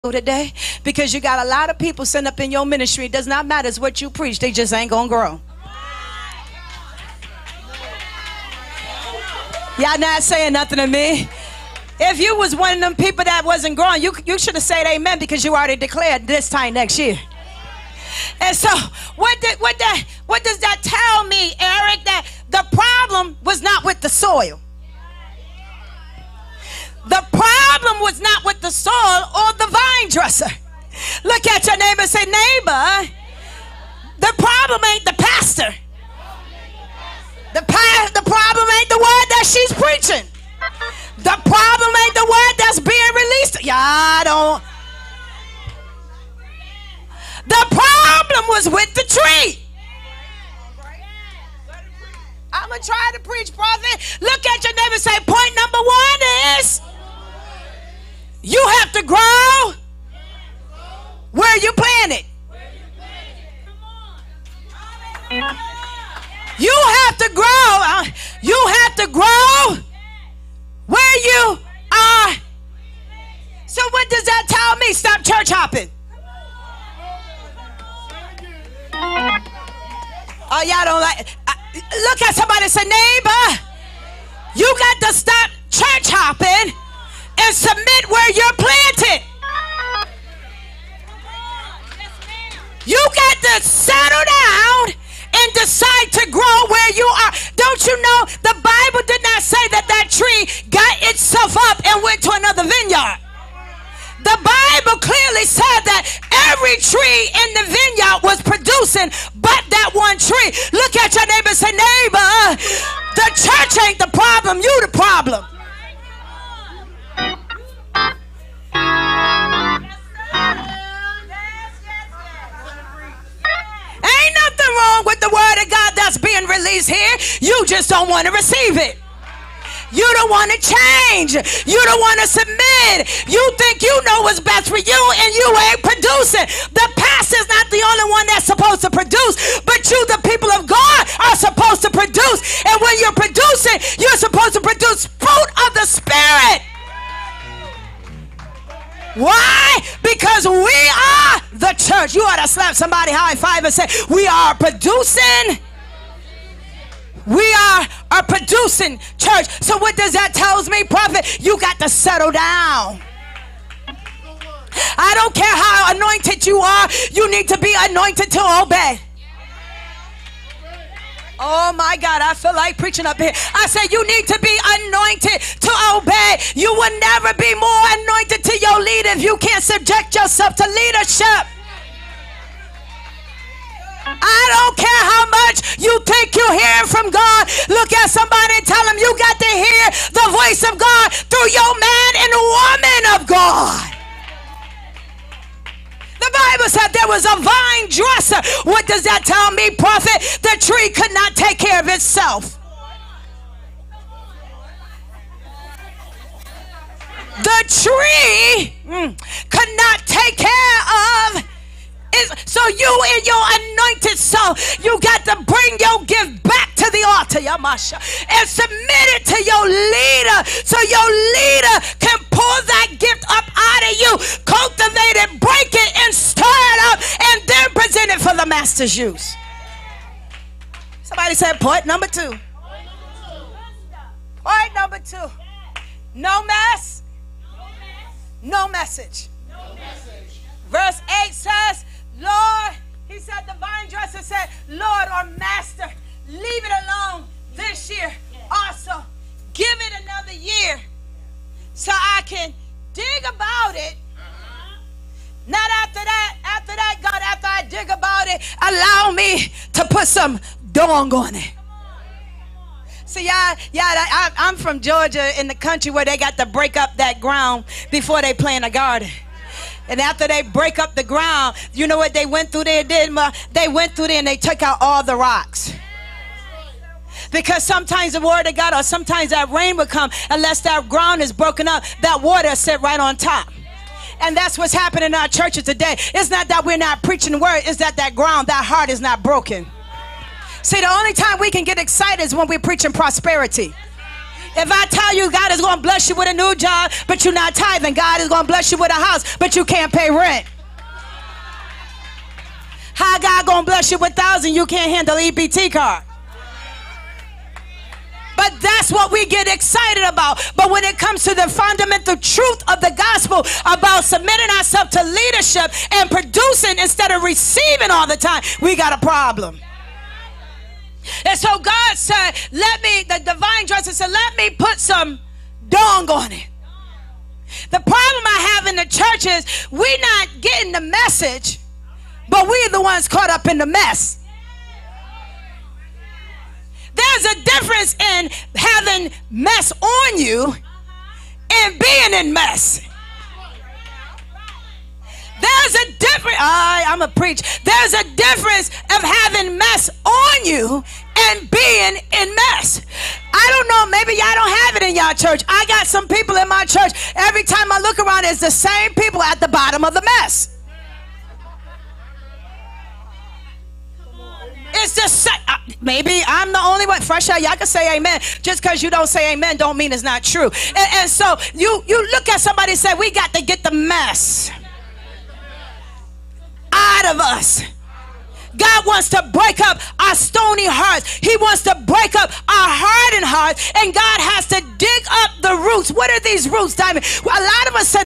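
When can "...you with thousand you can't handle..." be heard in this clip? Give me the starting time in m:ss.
5:03.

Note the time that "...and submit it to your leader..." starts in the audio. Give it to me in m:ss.
3:38.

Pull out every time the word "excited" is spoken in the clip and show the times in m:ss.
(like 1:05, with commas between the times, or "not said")
4:51, 5:09.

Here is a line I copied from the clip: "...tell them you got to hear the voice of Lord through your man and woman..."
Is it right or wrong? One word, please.
wrong.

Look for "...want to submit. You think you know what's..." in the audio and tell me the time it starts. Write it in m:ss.
2:11.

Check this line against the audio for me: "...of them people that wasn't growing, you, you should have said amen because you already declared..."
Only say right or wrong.
right.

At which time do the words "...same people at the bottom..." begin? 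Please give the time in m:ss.
5:58.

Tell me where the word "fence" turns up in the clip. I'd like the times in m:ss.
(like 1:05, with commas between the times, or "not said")
not said.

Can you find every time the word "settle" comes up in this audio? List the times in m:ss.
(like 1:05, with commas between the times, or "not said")
1:33, 2:41.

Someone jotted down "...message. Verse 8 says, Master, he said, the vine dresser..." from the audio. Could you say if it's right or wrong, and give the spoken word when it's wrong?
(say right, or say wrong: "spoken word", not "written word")
wrong: "Lord", not "Master".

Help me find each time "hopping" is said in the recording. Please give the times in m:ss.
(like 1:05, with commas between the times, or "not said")
1:15, 1:26.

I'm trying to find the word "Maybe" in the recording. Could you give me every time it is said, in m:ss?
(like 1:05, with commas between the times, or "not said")
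5:53, 6:05.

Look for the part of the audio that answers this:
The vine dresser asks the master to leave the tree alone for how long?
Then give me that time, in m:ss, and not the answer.
4:10.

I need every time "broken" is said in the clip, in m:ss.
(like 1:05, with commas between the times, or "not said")
4:41, 4:49.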